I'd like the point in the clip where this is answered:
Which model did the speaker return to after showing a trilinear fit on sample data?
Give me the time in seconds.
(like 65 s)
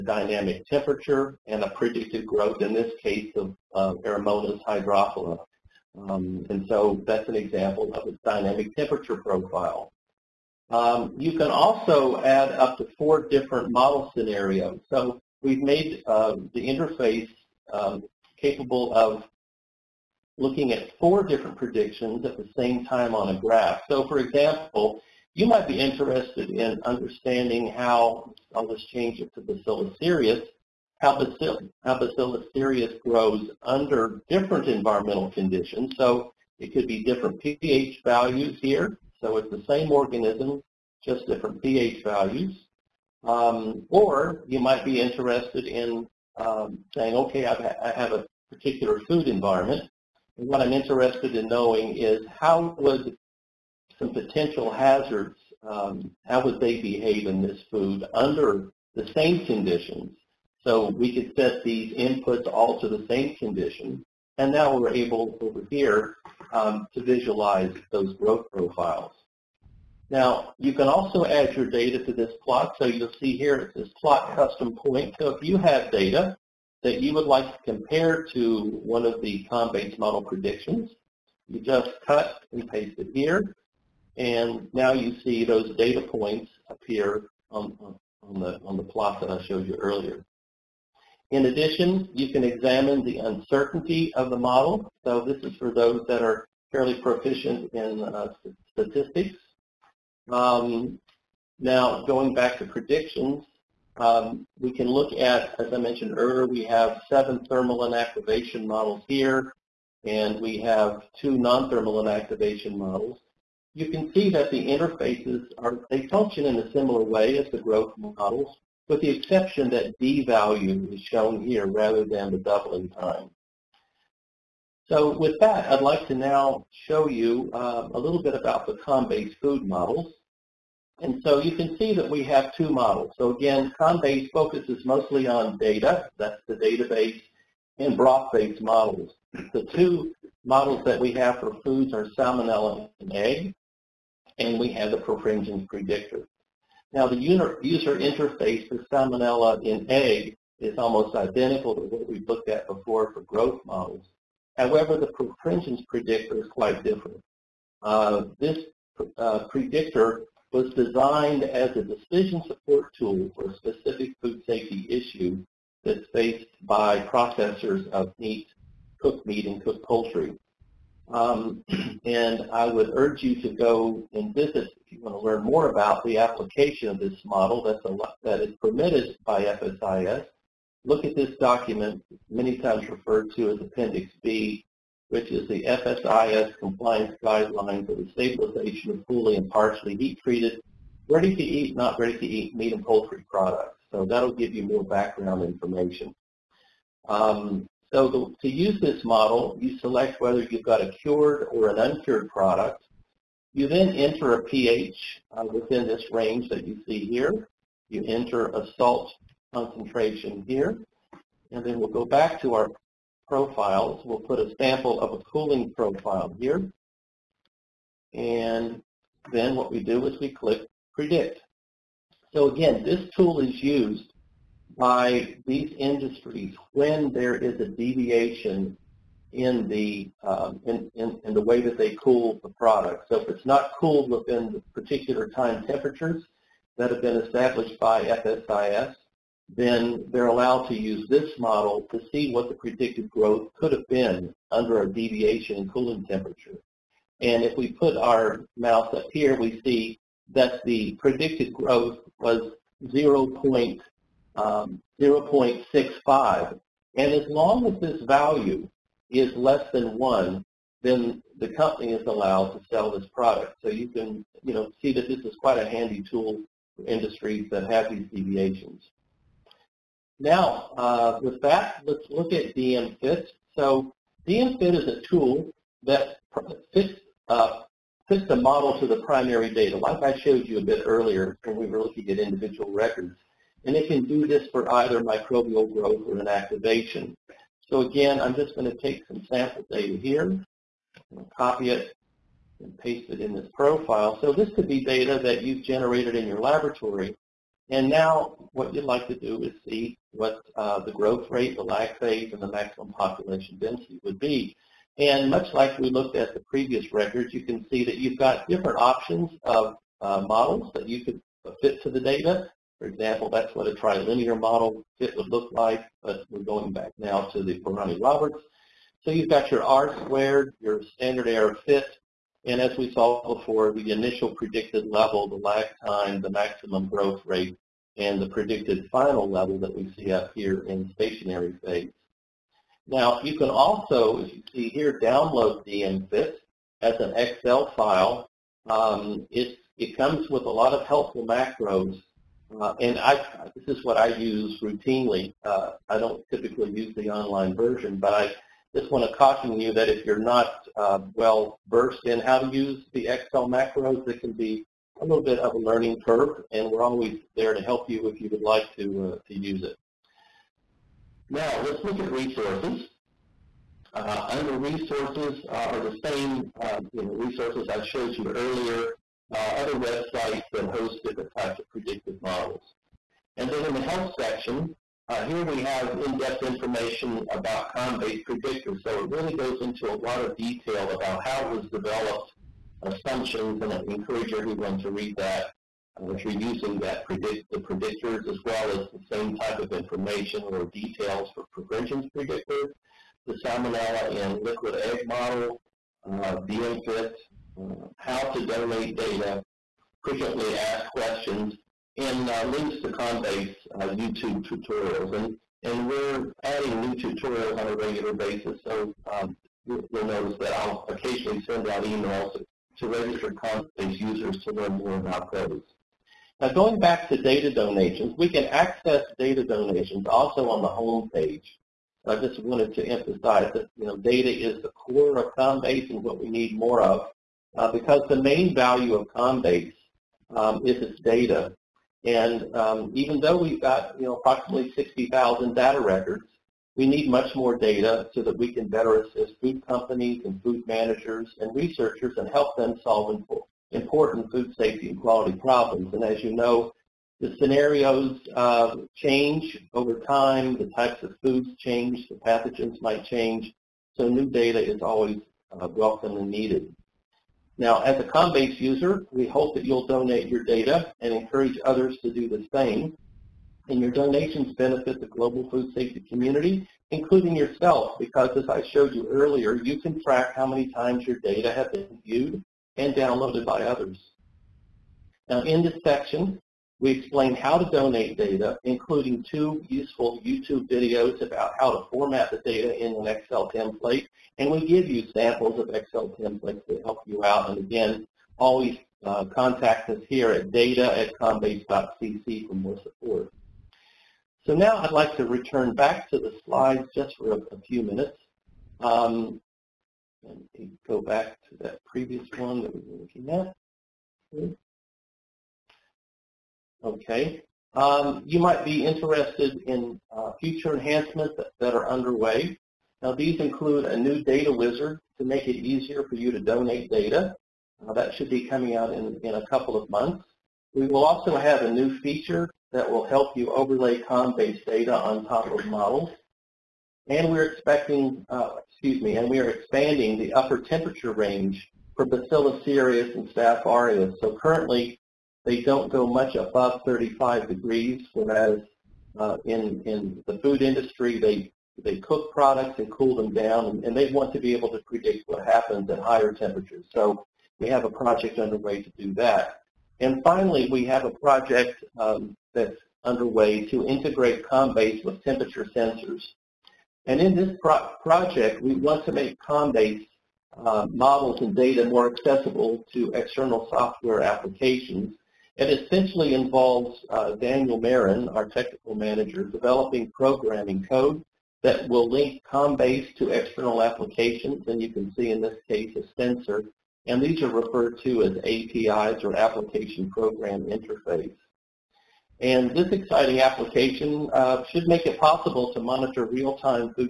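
317 s.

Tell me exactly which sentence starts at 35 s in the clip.
So it could be different pH values here.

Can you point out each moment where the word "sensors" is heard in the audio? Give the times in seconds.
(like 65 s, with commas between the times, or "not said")
555 s, 576 s.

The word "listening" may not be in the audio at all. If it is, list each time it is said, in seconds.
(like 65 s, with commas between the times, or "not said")
not said.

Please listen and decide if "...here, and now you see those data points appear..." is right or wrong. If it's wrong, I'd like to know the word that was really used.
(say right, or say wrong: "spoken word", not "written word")
right.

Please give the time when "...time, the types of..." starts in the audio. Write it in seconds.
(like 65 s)
449 s.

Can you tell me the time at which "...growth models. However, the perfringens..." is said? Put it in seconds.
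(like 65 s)
153 s.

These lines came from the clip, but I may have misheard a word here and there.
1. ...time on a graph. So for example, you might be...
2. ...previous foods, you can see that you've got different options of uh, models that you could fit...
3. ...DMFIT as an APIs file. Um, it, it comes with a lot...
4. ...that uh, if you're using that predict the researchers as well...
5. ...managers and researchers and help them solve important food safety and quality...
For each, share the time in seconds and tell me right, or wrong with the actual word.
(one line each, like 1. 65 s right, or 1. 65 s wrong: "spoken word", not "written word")
1. 22 s right
2. 306 s wrong: "records", not "foods"
3. 335 s wrong: "Excel", not "APIs"
4. 385 s wrong: "predictors", not "researchers"
5. 440 s right.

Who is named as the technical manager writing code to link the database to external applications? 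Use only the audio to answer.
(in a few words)
Daniel Marin.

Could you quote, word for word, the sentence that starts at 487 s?
And again, always uh, contact us here at data at combase.cc for more support.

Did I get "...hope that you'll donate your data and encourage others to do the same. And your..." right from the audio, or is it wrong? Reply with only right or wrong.
right.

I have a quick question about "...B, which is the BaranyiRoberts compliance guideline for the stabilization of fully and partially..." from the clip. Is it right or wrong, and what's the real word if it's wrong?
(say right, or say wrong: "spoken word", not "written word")
wrong: "FSIS", not "BaranyiRoberts".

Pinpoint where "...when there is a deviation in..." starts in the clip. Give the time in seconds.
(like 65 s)
226 s.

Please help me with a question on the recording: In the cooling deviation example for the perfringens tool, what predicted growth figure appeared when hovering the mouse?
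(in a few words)
0.65.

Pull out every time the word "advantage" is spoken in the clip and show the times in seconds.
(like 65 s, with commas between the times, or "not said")
not said.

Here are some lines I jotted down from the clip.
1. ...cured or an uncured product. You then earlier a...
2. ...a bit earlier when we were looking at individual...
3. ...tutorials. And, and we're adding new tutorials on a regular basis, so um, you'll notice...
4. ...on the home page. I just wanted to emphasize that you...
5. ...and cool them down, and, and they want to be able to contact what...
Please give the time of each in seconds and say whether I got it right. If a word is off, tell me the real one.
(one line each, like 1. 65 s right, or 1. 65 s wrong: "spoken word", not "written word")
1. 200 s wrong: "enter", not "earlier"
2. 280 s right
3. 404 s right
4. 420 s right
5. 542 s wrong: "predict", not "contact".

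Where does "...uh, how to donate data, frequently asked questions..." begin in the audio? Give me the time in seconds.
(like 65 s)
397 s.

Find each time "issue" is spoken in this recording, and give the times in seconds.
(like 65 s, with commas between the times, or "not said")
164 s.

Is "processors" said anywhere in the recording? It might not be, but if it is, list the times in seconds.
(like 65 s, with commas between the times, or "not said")
166 s.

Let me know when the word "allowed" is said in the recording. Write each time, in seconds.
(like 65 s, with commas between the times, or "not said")
240 s, 262 s.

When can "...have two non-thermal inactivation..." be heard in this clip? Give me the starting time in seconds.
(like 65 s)
110 s.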